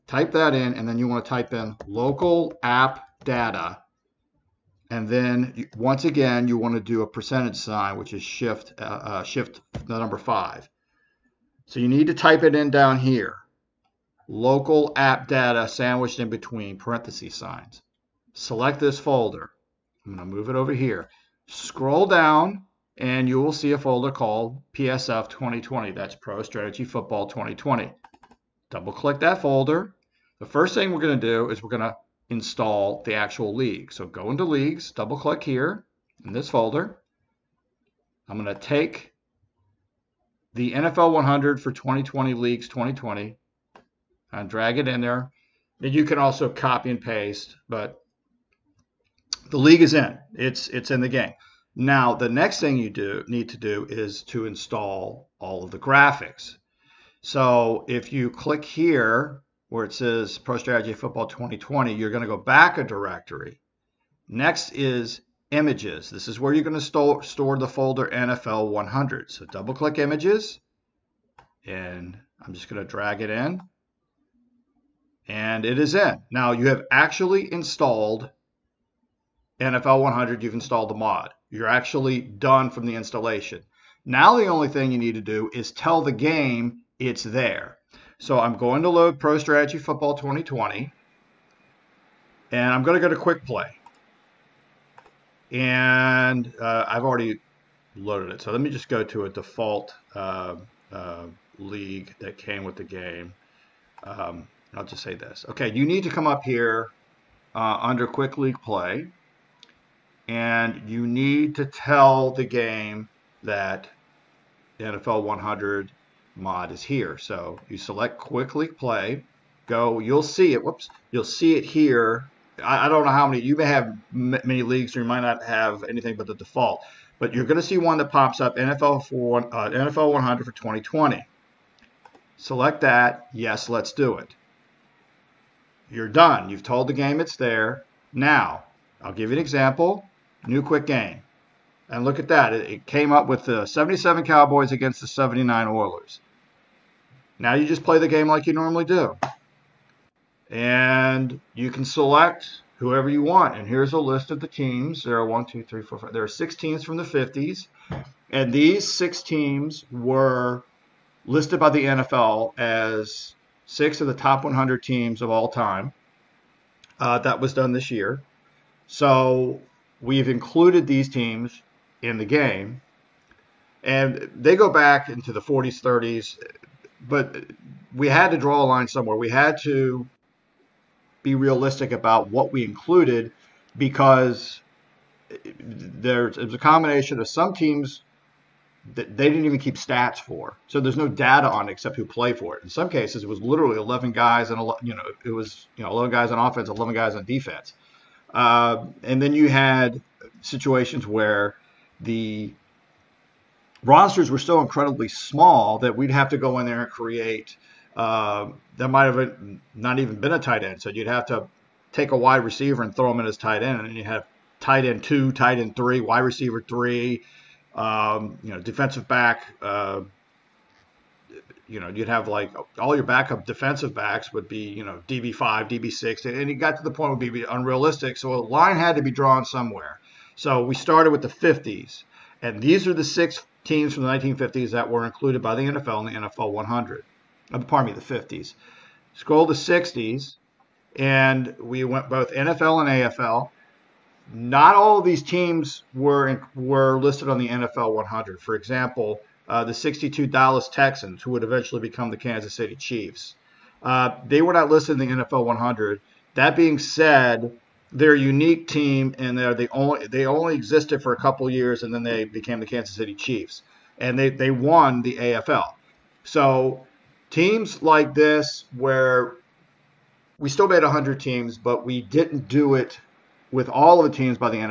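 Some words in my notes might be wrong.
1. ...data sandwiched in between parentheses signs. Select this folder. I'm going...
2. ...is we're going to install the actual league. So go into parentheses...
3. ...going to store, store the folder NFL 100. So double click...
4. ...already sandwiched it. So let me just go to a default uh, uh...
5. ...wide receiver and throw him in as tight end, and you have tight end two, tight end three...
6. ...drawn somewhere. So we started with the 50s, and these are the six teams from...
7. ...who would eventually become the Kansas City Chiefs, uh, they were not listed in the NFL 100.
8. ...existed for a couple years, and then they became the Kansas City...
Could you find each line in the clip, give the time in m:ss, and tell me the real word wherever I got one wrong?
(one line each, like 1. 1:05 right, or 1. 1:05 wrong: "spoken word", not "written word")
1. 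0:15 right
2. 0:31 wrong: "leagues", not "parentheses"
3. 1:06 right
4. 1:37 wrong: "loaded", not "sandwiched"
5. 3:32 right
6. 3:49 right
7. 4:11 right
8. 4:20 right.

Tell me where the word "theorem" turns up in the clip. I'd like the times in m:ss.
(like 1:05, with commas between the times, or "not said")
not said.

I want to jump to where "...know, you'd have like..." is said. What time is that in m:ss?
3:41.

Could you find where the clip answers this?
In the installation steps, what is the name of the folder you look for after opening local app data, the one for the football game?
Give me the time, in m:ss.
0:24.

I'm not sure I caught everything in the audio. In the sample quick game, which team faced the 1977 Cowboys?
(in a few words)
79 Oilers.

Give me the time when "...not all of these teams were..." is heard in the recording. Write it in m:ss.
4:04.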